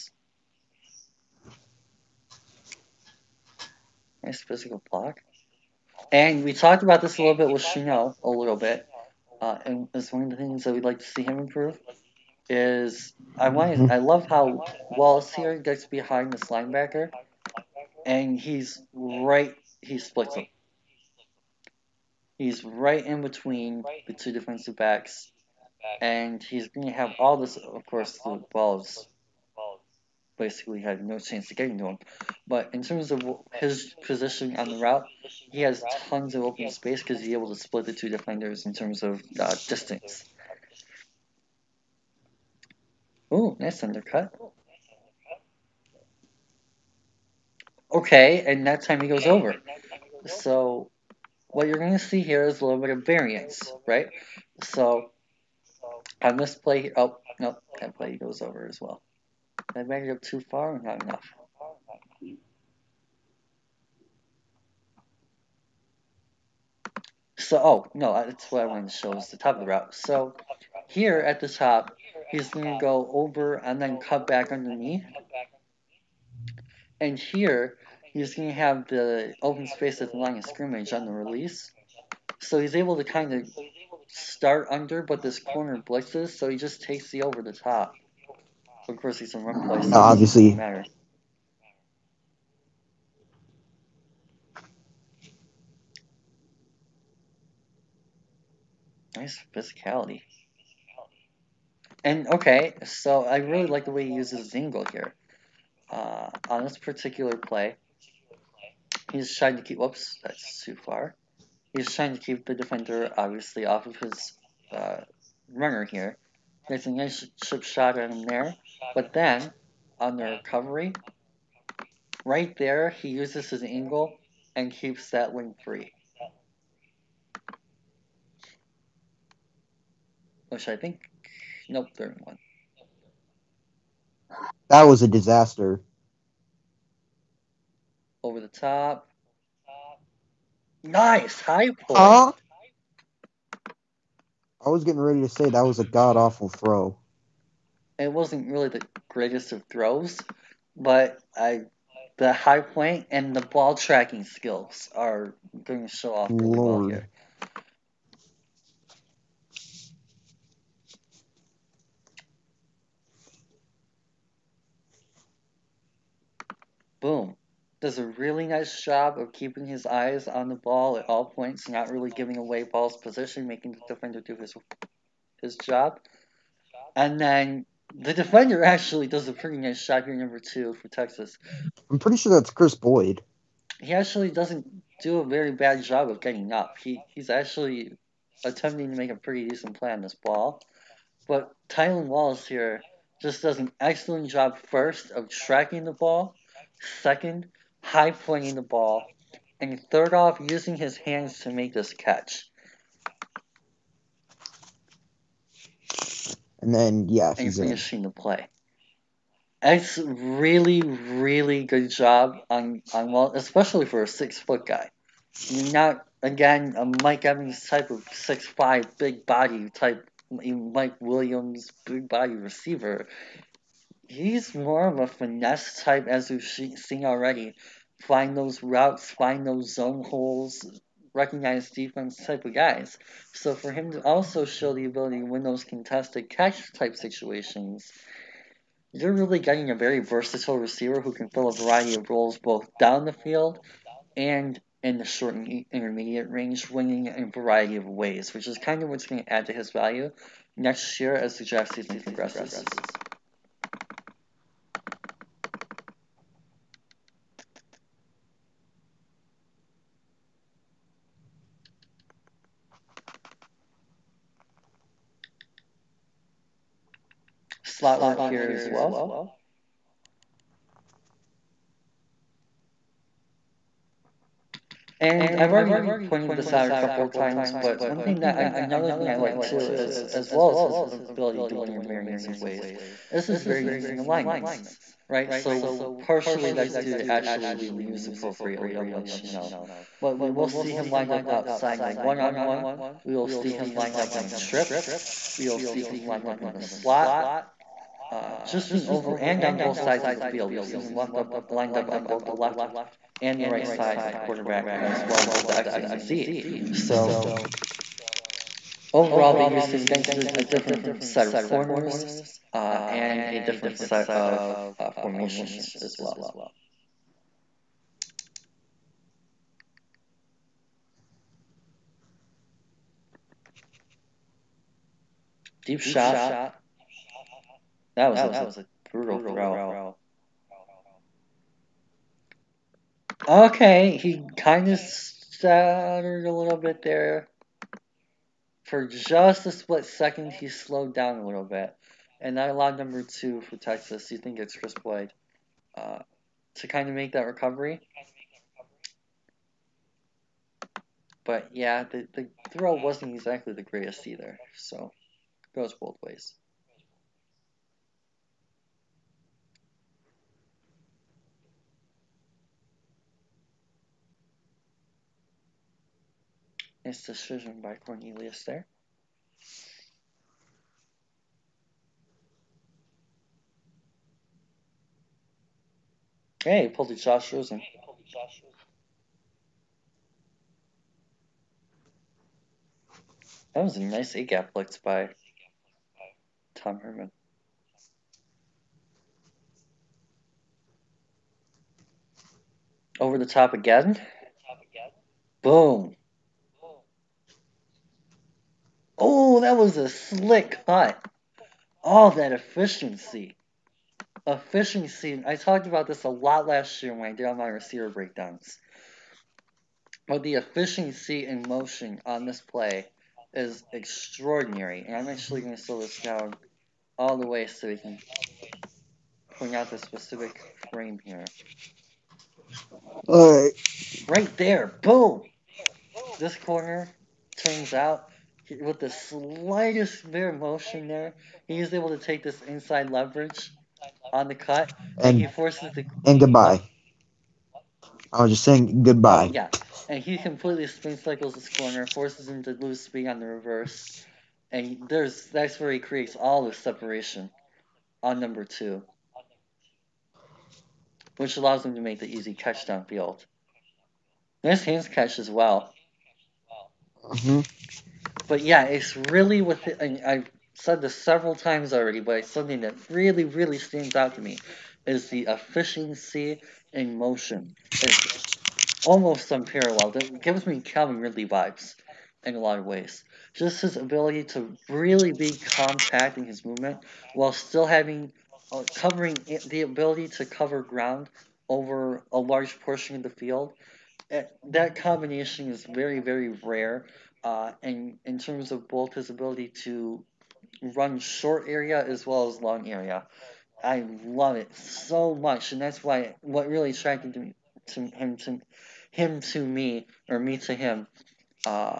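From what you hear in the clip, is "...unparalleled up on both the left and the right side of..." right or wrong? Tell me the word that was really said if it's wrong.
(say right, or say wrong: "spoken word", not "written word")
wrong: "lined", not "unparalleled".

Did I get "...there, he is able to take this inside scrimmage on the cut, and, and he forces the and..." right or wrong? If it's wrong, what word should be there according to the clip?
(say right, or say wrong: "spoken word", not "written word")
wrong: "leverage", not "scrimmage".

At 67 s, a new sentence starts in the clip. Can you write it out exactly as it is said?
So, oh, no, that's what I wanted to show is the top of the route.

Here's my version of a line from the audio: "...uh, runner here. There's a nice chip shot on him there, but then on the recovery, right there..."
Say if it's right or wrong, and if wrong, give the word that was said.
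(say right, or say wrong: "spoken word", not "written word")
right.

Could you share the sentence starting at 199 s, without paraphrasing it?
And third off, using his hands to make this catch.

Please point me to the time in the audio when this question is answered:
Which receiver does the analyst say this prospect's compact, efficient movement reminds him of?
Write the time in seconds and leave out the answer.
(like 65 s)
470 s.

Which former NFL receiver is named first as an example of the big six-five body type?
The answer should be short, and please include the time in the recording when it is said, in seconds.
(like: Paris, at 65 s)
Mike Evans, at 217 s.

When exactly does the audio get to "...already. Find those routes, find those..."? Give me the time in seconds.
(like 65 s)
227 s.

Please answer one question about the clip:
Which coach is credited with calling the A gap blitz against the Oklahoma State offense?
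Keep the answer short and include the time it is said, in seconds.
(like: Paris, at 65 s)
Tom Herman, at 386 s.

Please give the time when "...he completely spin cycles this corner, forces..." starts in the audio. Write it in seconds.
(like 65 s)
440 s.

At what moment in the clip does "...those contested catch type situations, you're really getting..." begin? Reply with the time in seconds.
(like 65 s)
235 s.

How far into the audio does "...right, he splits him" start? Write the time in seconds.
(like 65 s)
18 s.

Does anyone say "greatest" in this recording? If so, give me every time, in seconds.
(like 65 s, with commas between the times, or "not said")
149 s, 353 s.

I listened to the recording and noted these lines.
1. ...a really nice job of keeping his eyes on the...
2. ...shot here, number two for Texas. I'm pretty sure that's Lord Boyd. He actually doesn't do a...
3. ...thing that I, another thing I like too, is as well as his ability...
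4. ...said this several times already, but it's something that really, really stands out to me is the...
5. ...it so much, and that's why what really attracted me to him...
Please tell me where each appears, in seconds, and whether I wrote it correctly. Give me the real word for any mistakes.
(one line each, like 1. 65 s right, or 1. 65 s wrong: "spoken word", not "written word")
1. 167 s right
2. 179 s wrong: "Kris", not "Lord"
3. 278 s right
4. 460 s right
5. 494 s right.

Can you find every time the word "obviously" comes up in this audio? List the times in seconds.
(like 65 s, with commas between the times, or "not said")
89 s, 113 s.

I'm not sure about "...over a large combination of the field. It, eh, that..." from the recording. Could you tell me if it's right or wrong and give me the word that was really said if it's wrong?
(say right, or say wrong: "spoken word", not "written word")
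wrong: "portion", not "combination".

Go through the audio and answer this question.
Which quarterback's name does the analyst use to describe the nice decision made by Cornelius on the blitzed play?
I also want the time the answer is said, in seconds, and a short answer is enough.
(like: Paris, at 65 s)
Josh Rosen, at 376 s.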